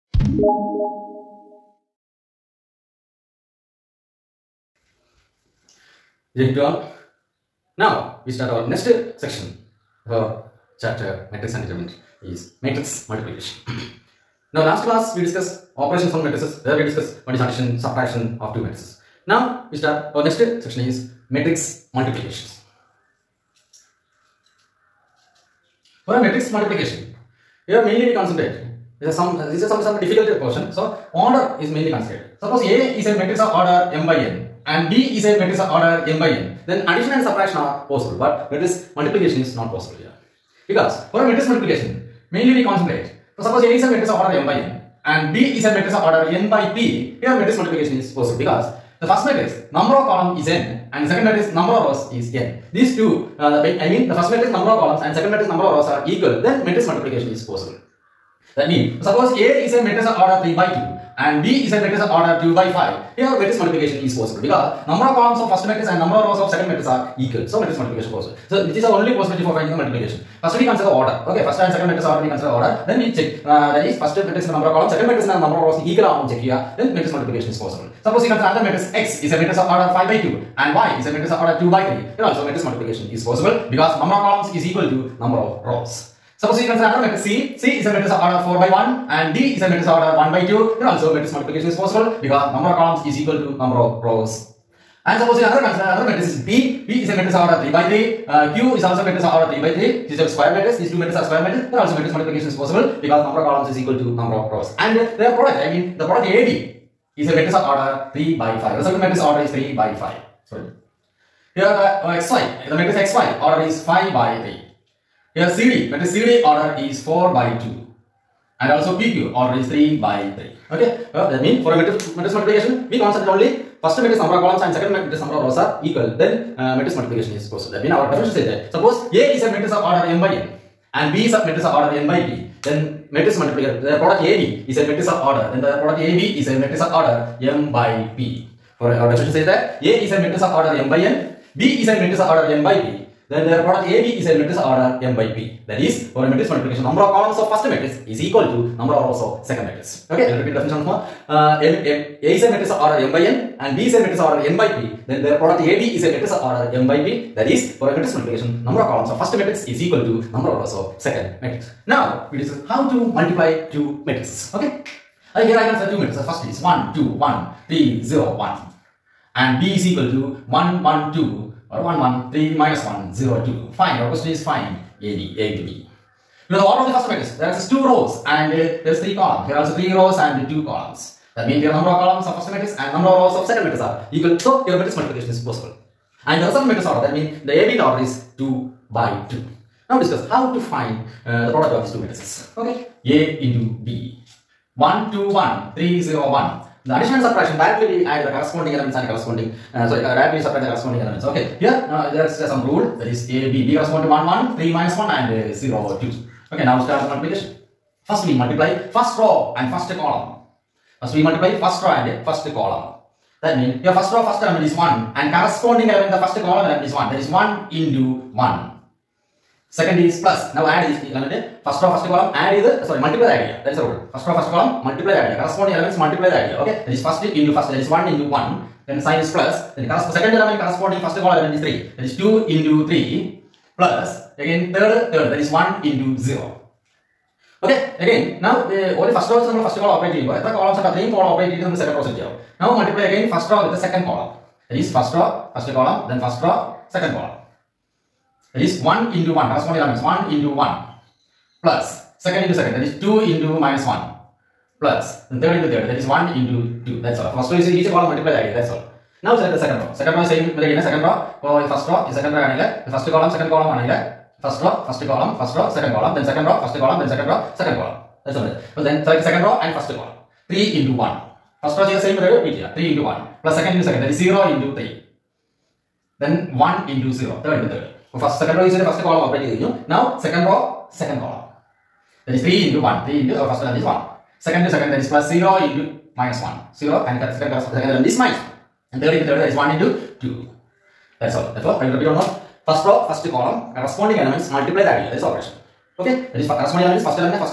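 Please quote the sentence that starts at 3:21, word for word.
Okay, here uh, there is uh, some rule that is A, B.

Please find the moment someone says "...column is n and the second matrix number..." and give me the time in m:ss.
0:50.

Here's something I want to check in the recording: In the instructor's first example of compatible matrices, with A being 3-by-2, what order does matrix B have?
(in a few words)
2 by 5.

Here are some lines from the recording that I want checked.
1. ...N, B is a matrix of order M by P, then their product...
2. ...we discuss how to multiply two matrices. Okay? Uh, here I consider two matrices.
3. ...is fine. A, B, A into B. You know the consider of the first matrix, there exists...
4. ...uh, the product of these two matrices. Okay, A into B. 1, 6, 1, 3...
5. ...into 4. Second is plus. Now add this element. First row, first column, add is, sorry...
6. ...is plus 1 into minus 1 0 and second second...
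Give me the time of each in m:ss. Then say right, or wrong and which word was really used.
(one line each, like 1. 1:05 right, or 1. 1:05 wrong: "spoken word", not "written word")
1. 2:20 right
2. 2:42 right
3. 2:54 wrong: "order", not "consider"
4. 3:11 wrong: "2", not "6"
5. 3:37 wrong: "1", not "4"
6. 4:45 wrong: "0", not "1".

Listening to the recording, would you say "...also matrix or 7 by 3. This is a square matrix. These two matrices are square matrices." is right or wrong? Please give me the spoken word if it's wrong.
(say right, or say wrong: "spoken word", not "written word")
wrong: "3", not "7".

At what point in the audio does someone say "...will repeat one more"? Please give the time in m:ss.
4:51.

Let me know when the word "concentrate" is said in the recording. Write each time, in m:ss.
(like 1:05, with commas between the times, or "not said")
0:28, 0:42.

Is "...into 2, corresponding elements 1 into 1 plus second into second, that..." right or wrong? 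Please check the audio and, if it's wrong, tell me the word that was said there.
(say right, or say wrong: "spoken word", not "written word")
wrong: "1", not "2".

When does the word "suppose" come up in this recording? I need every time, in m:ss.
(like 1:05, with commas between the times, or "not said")
0:32, 0:43, 0:59, 1:18, 1:26, 1:35, 2:08.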